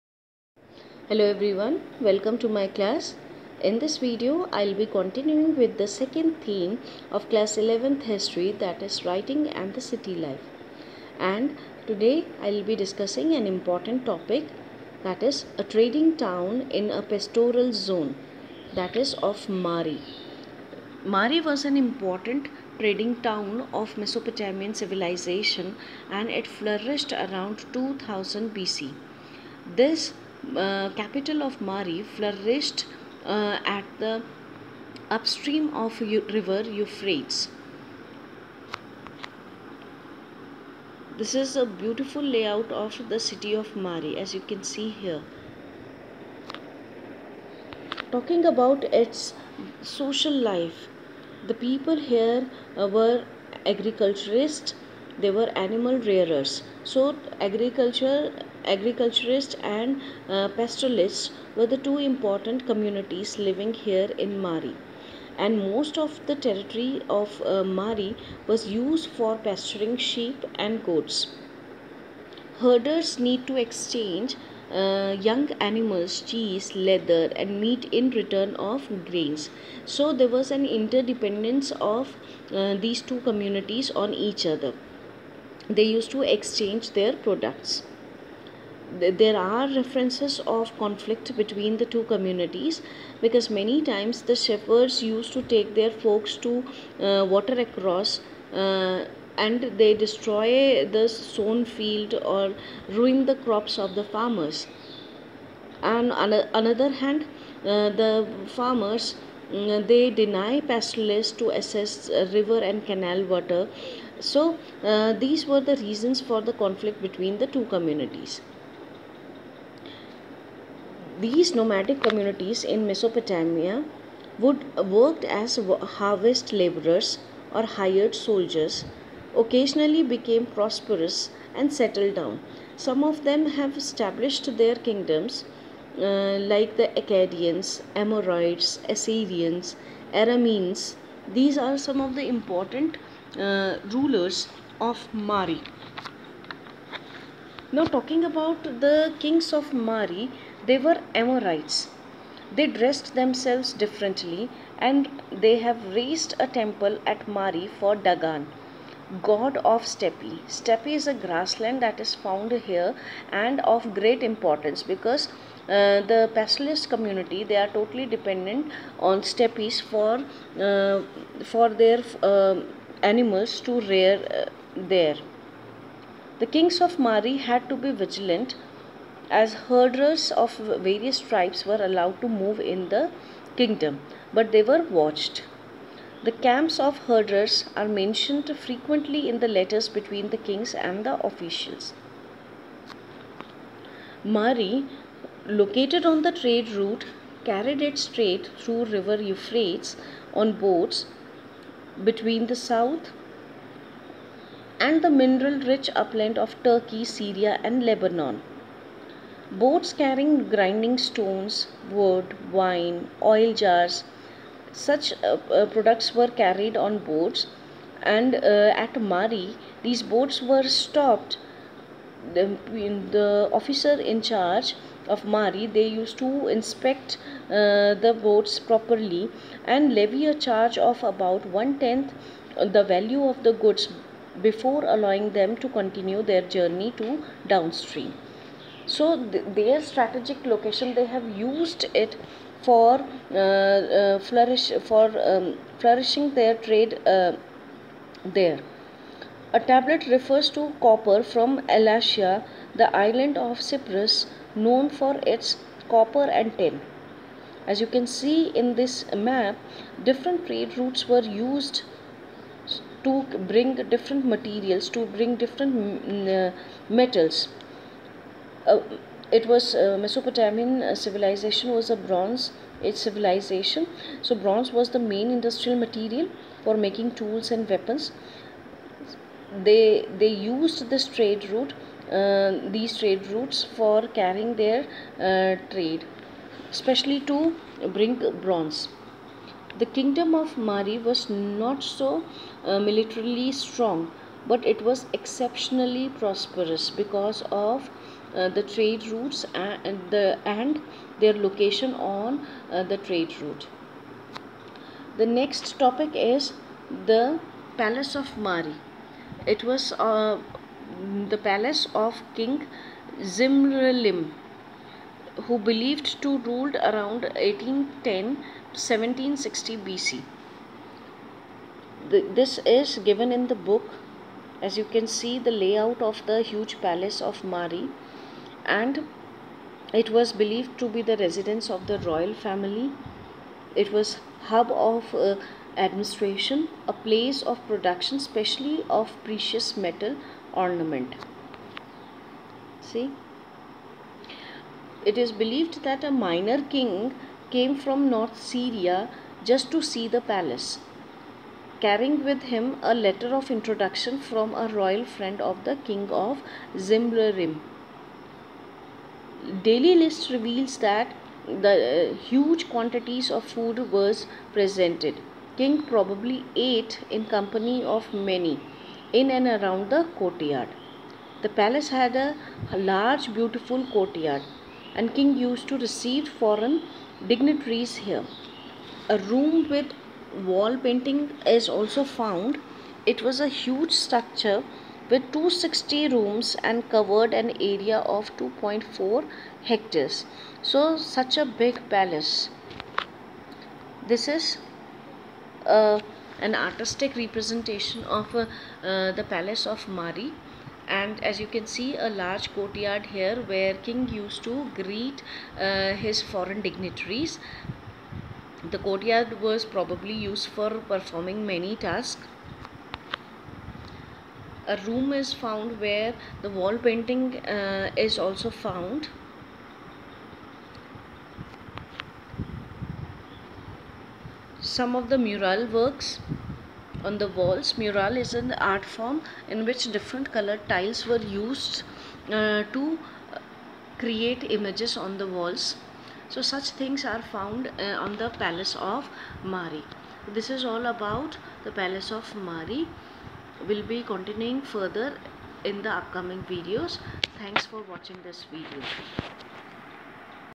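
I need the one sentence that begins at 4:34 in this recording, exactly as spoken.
So bronze was the main industrial material for making tools and weapons.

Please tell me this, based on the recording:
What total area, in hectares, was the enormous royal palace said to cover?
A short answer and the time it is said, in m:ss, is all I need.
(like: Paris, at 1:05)
2.4 hectares, at 6:28.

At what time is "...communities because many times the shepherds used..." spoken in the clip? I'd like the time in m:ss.
1:32.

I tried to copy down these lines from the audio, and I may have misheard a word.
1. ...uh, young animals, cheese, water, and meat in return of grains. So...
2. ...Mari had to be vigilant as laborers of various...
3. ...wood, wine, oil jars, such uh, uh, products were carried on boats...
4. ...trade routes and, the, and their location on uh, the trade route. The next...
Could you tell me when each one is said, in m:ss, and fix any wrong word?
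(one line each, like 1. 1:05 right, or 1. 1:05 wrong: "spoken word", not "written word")
1. 1:14 wrong: "leather", not "water"
2. 2:56 wrong: "herders", not "laborers"
3. 3:31 right
4. 4:58 right.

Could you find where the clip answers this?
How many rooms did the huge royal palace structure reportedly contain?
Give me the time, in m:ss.
6:25.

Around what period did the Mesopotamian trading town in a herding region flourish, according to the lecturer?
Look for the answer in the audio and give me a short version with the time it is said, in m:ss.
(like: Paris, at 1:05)
2000 BC, at 0:27.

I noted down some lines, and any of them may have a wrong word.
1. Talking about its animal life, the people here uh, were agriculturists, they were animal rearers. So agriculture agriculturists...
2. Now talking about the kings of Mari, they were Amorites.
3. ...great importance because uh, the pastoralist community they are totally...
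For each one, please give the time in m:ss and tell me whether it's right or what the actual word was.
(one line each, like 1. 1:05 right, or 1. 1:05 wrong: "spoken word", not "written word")
1. 0:48 wrong: "social", not "animal"
2. 2:27 right
3. 2:43 right.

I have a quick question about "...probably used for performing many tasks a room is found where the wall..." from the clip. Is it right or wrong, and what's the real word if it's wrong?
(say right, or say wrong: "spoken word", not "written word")
right.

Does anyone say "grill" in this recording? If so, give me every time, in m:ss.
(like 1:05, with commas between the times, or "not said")
not said.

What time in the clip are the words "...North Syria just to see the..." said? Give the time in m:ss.
5:48.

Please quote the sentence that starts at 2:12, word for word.
Some of them have established their kingdoms uh, like the Akkadians, Amorites, Assyrians, Arameans.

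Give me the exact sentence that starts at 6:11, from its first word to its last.
The palace had a large, beautiful courtyard, and King used to receive foreign dignitaries here.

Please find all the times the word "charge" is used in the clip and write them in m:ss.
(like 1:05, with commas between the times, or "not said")
3:44, 3:50.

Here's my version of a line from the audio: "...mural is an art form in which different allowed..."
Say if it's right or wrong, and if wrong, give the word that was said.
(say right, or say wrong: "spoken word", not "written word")
wrong: "colored", not "allowed".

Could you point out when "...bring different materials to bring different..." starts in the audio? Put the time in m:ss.
4:23.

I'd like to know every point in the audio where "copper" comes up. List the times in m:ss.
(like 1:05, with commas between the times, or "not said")
4:10, 4:15.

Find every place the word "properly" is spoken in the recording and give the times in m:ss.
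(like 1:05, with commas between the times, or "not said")
3:48.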